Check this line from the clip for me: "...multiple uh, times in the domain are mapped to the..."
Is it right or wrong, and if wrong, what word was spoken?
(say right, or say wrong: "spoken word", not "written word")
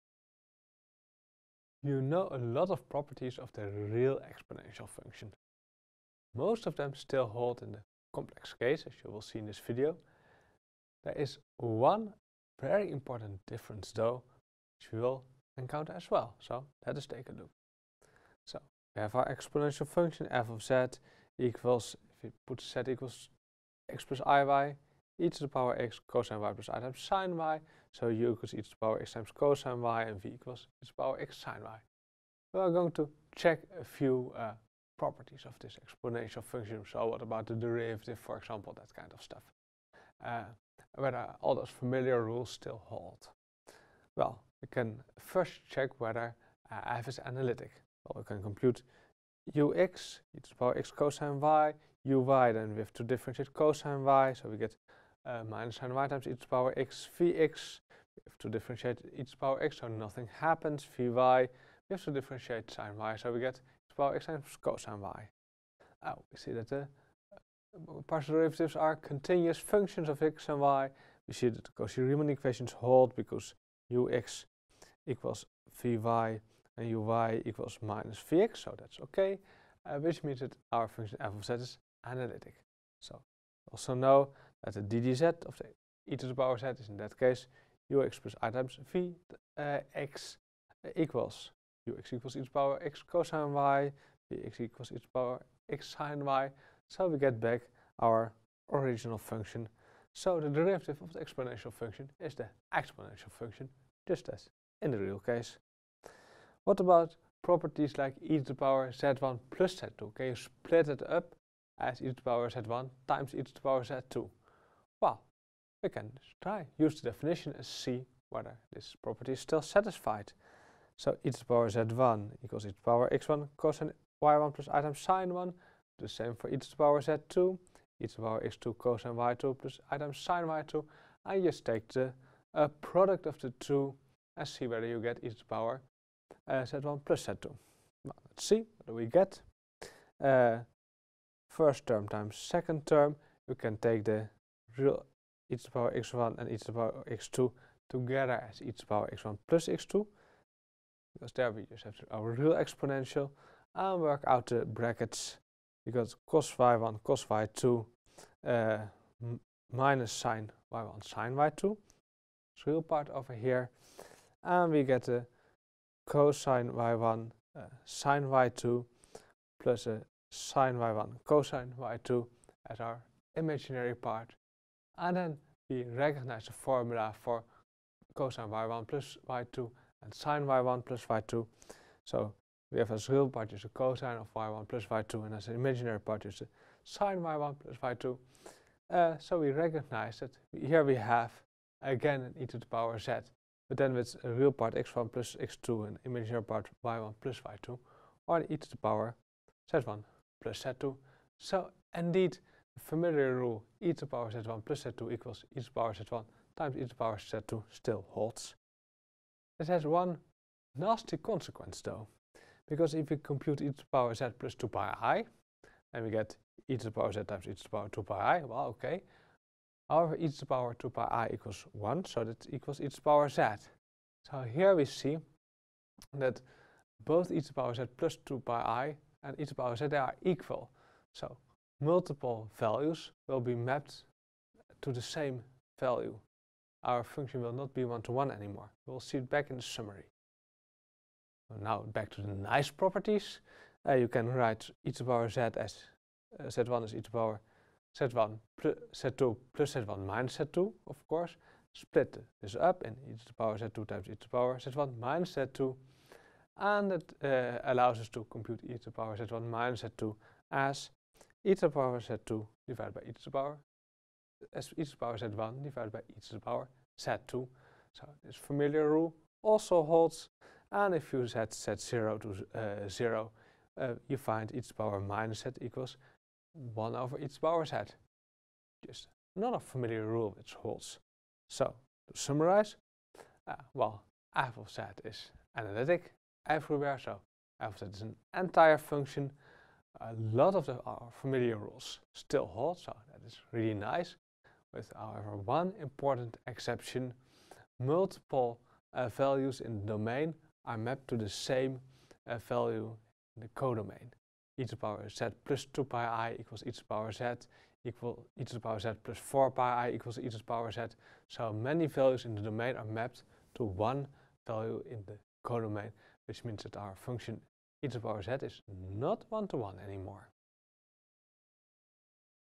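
wrong: "values", not "times".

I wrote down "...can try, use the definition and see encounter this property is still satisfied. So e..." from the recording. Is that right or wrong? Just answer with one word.
wrong.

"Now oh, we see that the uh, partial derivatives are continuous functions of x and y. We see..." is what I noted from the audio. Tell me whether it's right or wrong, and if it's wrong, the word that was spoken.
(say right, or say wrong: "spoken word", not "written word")
right.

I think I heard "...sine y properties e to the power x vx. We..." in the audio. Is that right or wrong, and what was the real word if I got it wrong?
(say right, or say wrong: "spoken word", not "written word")
wrong: "times", not "properties".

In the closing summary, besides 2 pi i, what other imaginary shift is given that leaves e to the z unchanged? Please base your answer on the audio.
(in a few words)
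4 pi i.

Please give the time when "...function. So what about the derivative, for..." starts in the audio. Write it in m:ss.
0:36.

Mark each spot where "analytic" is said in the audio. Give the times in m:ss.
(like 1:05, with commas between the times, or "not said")
0:47, 1:22, 4:45.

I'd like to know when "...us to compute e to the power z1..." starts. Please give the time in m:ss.
4:17.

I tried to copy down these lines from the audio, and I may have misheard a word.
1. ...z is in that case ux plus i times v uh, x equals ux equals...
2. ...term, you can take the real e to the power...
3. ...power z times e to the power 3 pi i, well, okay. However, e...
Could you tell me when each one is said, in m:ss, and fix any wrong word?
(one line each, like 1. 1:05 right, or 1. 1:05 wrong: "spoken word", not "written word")
1. 1:26 right
2. 2:22 right
3. 3:36 wrong: "2", not "3".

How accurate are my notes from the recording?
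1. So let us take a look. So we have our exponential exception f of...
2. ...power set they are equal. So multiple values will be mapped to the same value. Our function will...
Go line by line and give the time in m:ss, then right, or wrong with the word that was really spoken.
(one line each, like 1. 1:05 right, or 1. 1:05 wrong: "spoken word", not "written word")
1. 0:16 wrong: "function", not "exception"
2. 3:49 right.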